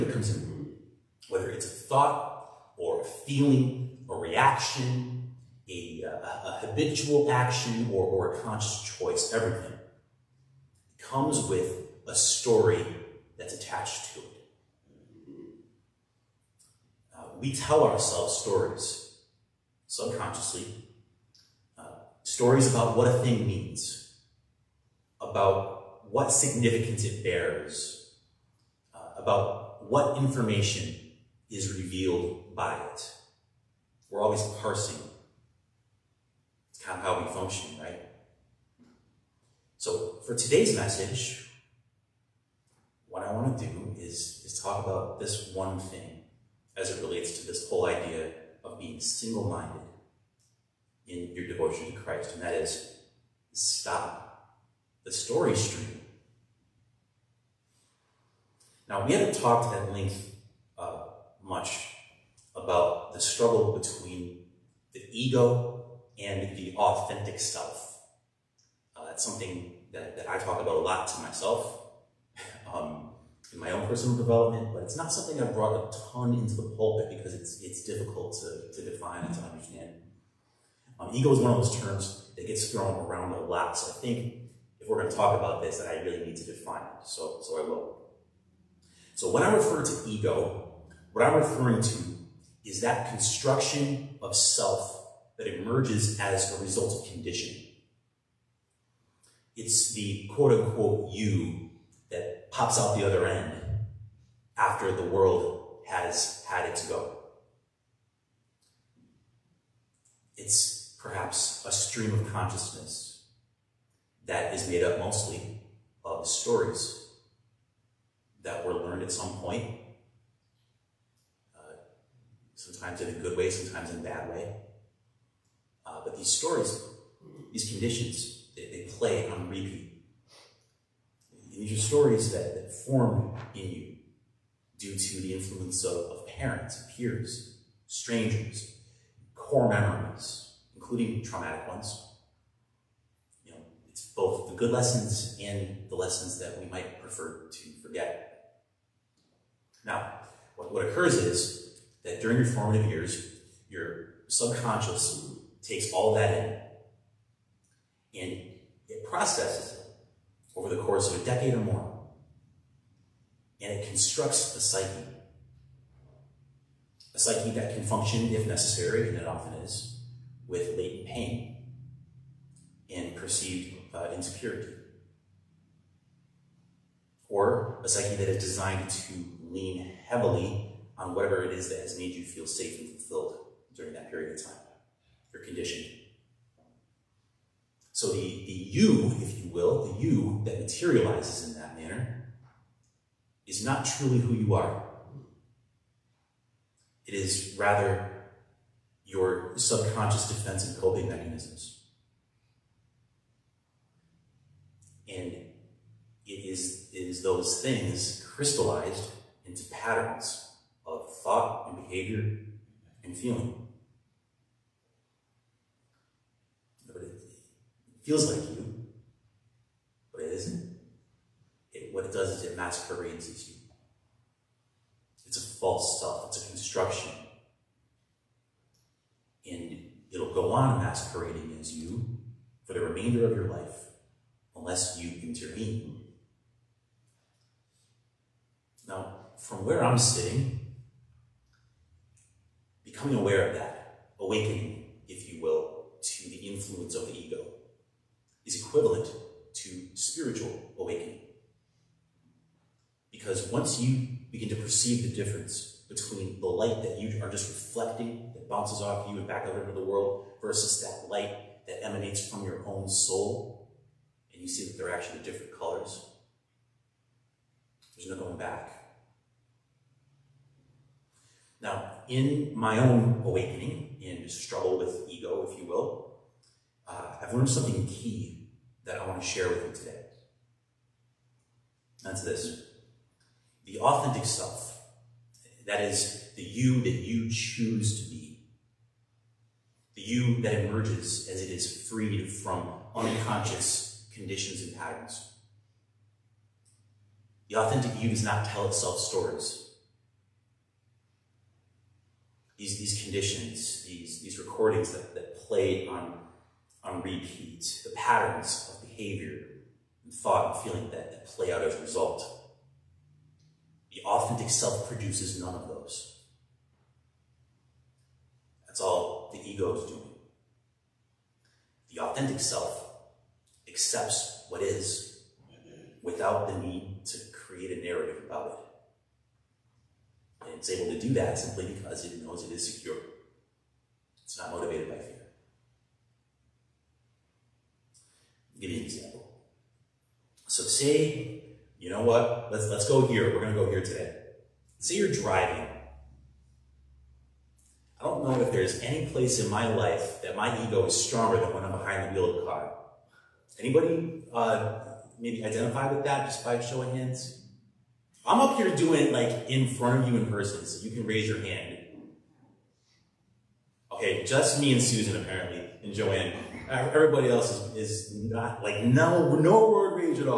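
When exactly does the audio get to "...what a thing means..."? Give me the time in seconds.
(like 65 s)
22 s.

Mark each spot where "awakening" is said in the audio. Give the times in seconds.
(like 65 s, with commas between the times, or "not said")
244 s, 250 s, 273 s.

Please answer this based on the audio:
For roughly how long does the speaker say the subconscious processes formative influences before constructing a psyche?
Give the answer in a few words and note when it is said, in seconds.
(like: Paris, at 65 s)
A decade or more, at 161 s.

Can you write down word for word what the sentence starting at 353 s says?
Anybody uh, maybe identify with that just by showing hands?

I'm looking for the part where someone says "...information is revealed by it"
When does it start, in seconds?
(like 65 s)
30 s.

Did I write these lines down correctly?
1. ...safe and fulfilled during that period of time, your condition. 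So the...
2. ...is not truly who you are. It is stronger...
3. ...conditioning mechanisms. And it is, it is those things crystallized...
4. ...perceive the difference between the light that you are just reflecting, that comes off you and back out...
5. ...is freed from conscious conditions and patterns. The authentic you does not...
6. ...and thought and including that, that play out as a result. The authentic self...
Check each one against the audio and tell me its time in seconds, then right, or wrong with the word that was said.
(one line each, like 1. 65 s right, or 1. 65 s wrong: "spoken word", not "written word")
1. 182 s right
2. 193 s wrong: "rather", not "stronger"
3. 200 s wrong: "coping", not "conditioning"
4. 254 s wrong: "bounces", not "comes"
5. 291 s wrong: "unconscious", not "conscious"
6. 310 s wrong: "feeling", not "including".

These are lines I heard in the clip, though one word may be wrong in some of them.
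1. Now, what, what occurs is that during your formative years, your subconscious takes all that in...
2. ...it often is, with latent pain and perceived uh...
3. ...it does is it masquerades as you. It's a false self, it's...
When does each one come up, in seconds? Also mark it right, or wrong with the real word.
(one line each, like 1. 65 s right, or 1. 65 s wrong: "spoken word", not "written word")
1. 149 s right
2. 169 s right
3. 222 s right.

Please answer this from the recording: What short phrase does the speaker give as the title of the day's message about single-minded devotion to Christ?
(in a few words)
Stop the story stream.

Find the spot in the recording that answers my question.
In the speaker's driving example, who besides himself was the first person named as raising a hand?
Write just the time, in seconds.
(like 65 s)
364 s.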